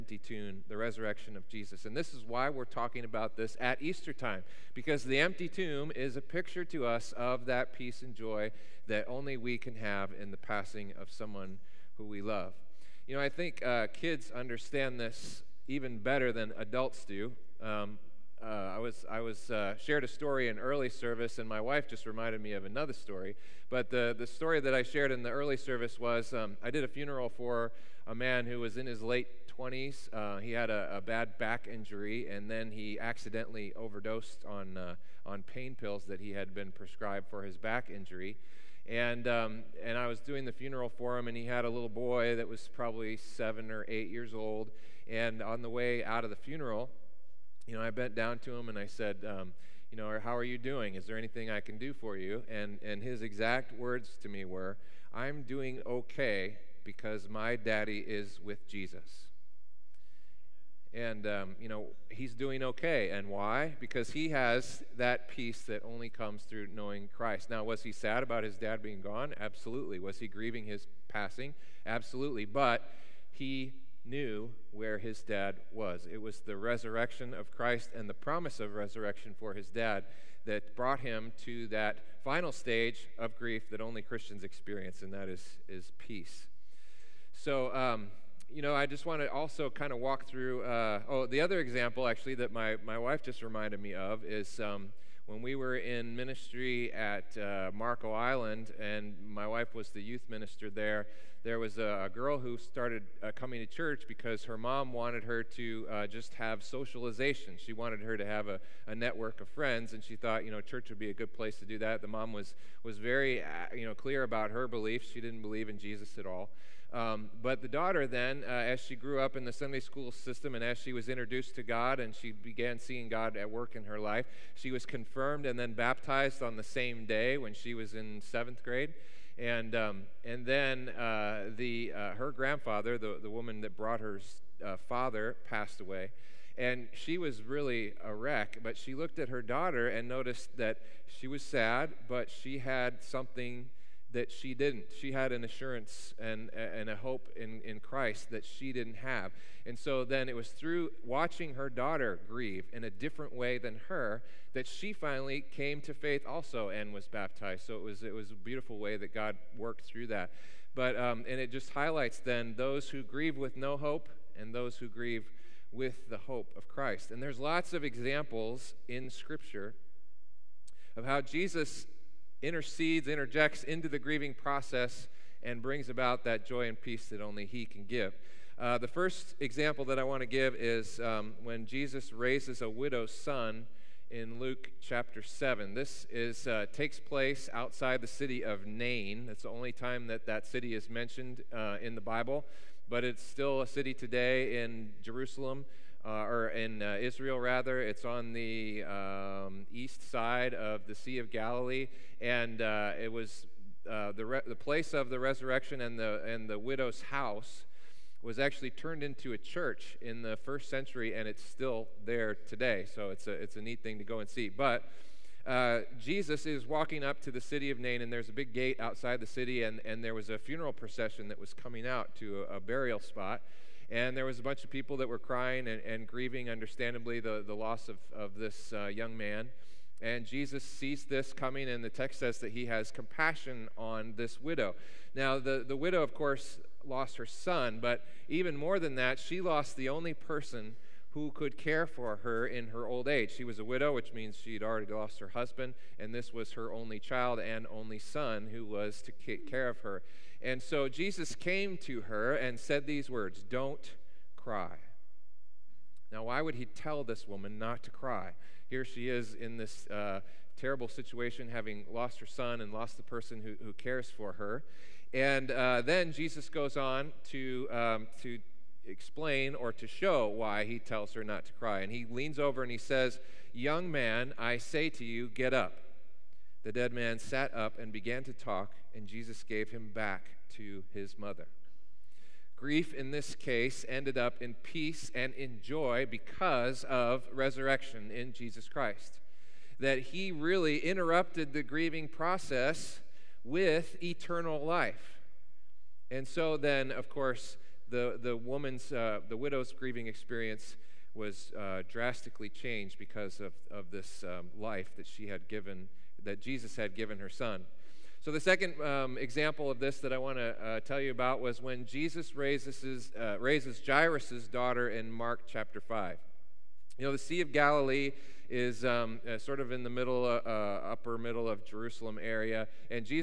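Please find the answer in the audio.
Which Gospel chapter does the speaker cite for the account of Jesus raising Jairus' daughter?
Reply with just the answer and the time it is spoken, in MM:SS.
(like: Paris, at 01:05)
Mark chapter 5, at 05:15.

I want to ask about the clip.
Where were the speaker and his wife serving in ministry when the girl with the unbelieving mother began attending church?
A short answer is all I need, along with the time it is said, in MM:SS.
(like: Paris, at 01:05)
Marco Island, at 01:37.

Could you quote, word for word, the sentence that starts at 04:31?
And he leans over and he says, Young man, I say to you, get up.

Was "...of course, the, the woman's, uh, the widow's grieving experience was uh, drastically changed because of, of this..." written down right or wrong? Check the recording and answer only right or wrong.
right.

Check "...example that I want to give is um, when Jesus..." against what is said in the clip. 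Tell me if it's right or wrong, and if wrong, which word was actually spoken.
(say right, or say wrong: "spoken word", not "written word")
right.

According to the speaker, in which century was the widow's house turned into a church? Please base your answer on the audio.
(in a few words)
first century.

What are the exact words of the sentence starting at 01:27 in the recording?
So, um, you know, I just want to also kind of walk through.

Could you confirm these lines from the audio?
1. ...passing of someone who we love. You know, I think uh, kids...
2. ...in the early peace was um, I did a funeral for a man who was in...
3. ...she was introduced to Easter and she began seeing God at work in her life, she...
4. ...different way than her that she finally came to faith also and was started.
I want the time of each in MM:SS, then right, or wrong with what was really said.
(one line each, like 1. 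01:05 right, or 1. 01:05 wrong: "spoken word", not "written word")
1. 00:10 right
2. 00:25 wrong: "service", not "peace"
3. 02:00 wrong: "God", not "Easter"
4. 02:32 wrong: "baptized", not "started".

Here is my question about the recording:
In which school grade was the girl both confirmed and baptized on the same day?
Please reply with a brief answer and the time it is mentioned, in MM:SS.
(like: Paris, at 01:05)
seventh grade, at 02:08.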